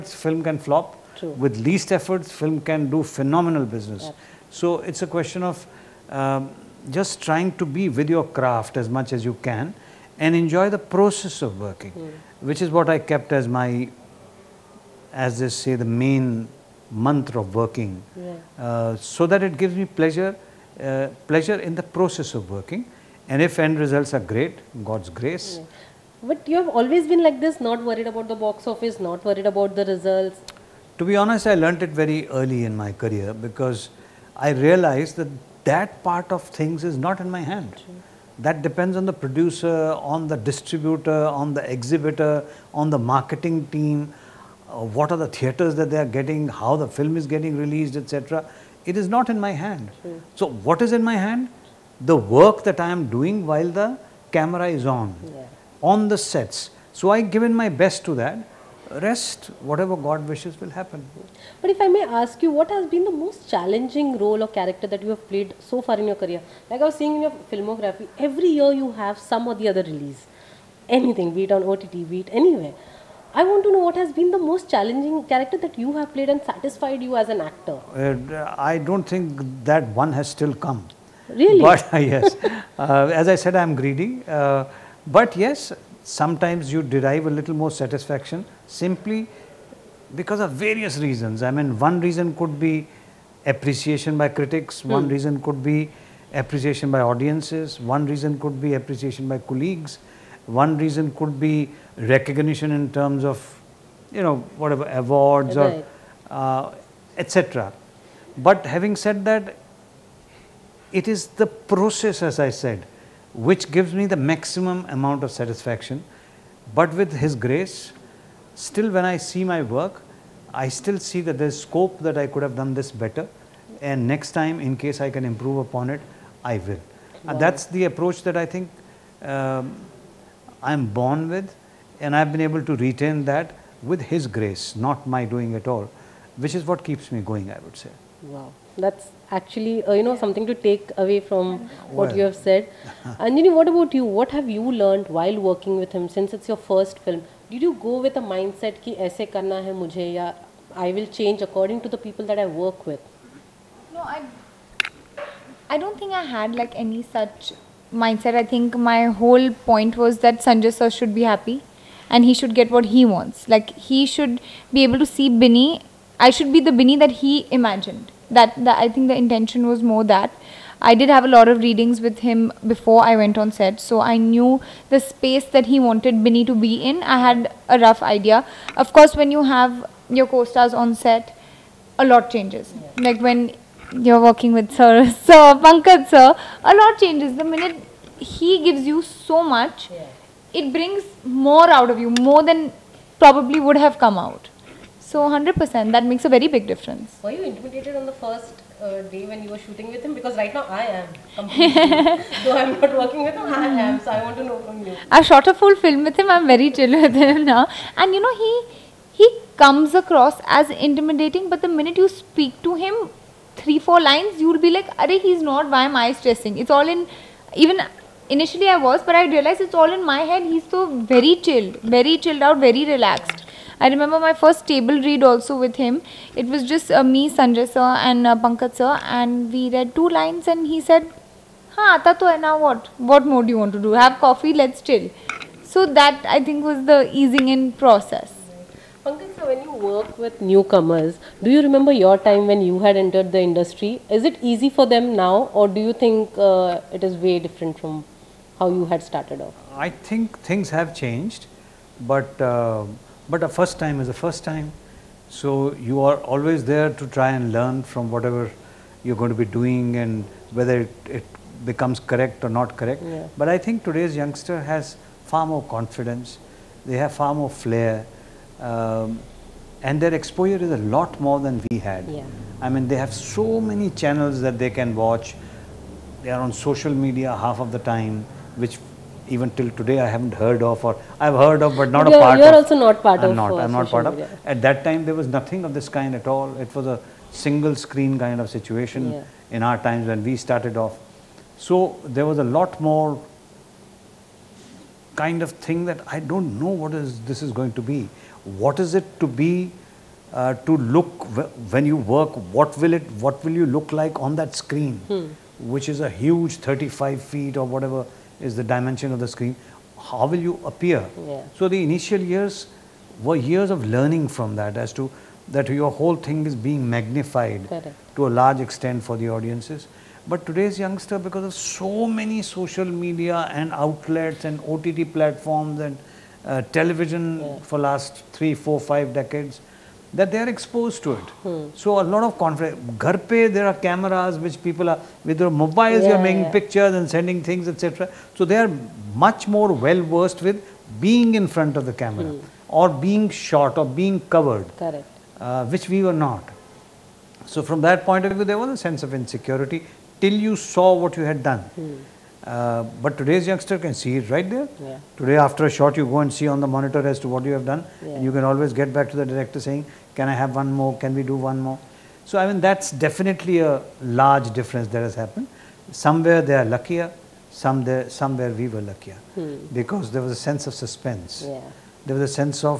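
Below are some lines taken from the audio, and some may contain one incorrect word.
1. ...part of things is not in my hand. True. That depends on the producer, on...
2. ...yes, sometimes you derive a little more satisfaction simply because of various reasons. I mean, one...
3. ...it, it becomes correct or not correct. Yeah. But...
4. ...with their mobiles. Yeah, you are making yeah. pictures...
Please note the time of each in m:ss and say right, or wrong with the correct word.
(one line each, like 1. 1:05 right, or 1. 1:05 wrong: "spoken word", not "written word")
1. 0:36 right
2. 1:25 right
3. 4:20 right
4. 5:35 right.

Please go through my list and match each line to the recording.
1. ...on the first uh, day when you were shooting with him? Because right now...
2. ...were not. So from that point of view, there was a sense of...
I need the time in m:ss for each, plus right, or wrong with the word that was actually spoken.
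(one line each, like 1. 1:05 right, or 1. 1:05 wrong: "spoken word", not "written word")
1. 3:17 right
2. 5:46 right.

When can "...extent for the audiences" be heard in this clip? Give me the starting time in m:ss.
5:18.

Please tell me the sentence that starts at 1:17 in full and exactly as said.
Uh, I don't think that one has still come.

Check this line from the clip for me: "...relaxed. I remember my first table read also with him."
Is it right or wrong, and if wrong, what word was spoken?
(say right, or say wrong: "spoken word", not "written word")
right.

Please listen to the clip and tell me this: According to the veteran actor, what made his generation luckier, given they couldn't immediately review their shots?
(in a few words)
suspense.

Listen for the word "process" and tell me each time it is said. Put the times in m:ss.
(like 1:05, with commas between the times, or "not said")
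0:10, 0:21, 1:51, 3:57.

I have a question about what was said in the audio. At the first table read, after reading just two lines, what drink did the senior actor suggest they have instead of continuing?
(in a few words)
coffee.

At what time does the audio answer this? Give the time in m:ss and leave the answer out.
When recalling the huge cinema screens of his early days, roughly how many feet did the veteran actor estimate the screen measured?
5:06.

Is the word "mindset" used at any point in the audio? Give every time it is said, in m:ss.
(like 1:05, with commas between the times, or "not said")
2:28, 2:37.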